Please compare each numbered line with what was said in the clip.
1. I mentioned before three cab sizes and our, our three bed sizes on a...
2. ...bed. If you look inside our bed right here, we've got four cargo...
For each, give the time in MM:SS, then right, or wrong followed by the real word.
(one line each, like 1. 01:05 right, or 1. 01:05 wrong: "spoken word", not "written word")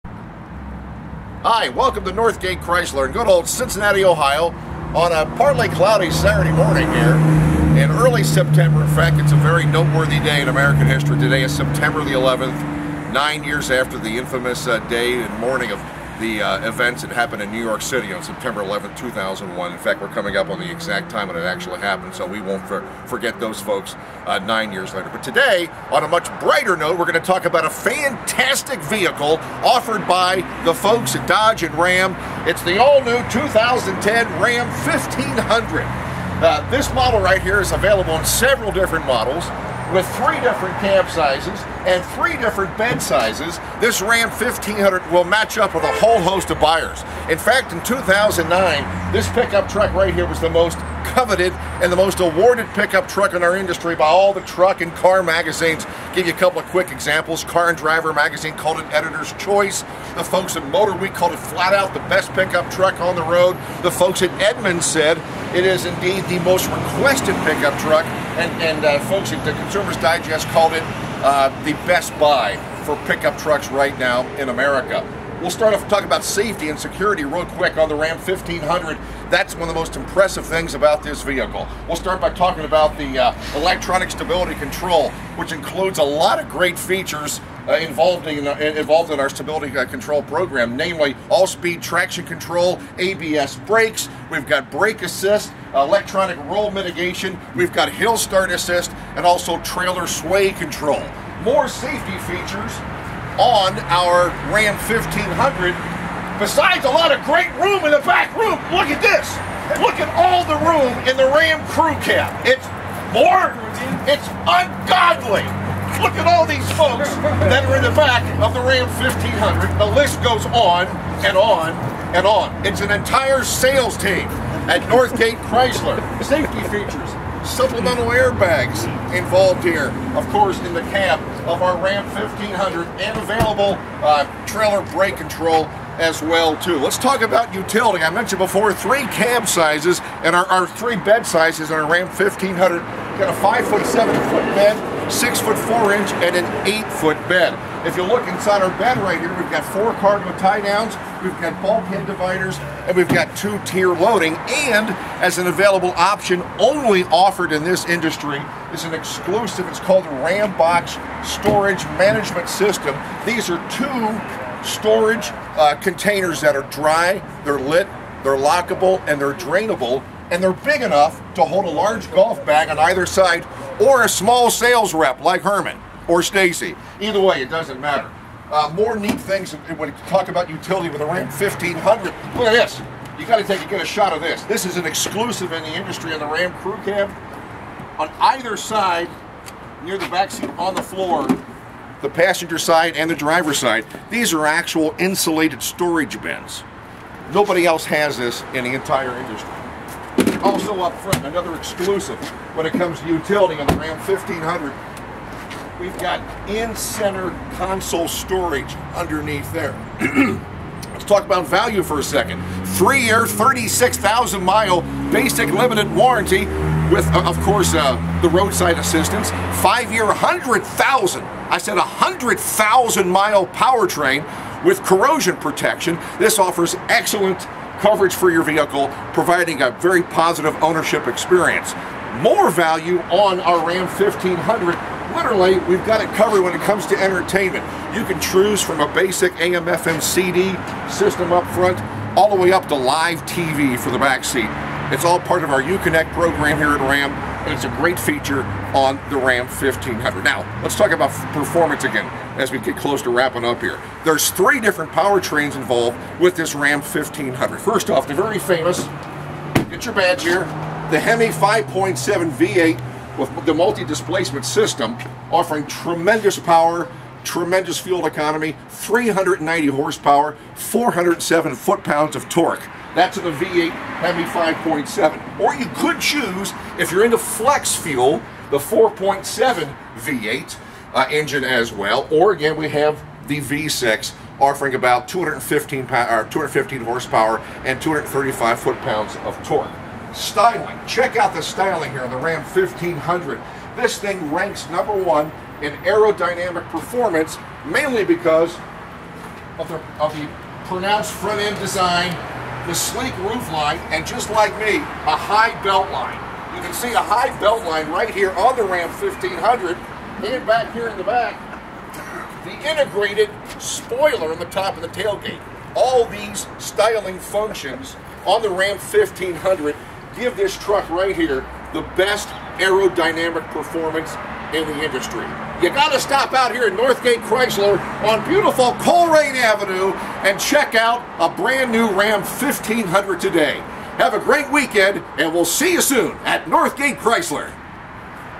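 1. 02:18 right
2. 02:27 right.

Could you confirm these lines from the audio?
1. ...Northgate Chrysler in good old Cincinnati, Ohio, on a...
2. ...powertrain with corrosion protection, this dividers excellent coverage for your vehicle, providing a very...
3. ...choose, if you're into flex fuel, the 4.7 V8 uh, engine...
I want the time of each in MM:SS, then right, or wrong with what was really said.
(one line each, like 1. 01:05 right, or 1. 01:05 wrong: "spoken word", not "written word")
1. 00:02 right
2. 03:43 wrong: "offers", not "dividers"
3. 04:36 right.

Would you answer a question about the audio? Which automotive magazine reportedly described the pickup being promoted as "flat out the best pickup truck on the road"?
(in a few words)
Motor Week.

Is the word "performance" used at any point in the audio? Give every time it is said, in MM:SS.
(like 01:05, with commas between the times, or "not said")
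04:11, 04:56, 05:23.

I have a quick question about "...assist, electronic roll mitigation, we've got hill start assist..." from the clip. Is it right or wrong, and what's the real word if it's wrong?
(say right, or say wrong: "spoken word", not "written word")
right.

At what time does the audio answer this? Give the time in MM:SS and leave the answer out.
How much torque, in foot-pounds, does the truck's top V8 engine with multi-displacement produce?
04:30.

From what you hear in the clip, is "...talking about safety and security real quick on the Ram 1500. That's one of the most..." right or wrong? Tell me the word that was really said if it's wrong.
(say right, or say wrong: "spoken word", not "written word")
right.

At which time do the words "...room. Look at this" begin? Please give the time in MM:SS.
01:48.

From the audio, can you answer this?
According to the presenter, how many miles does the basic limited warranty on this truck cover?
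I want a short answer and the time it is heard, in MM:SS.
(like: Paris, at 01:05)
36,000, at 03:33.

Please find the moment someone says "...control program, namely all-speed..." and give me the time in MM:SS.
01:29.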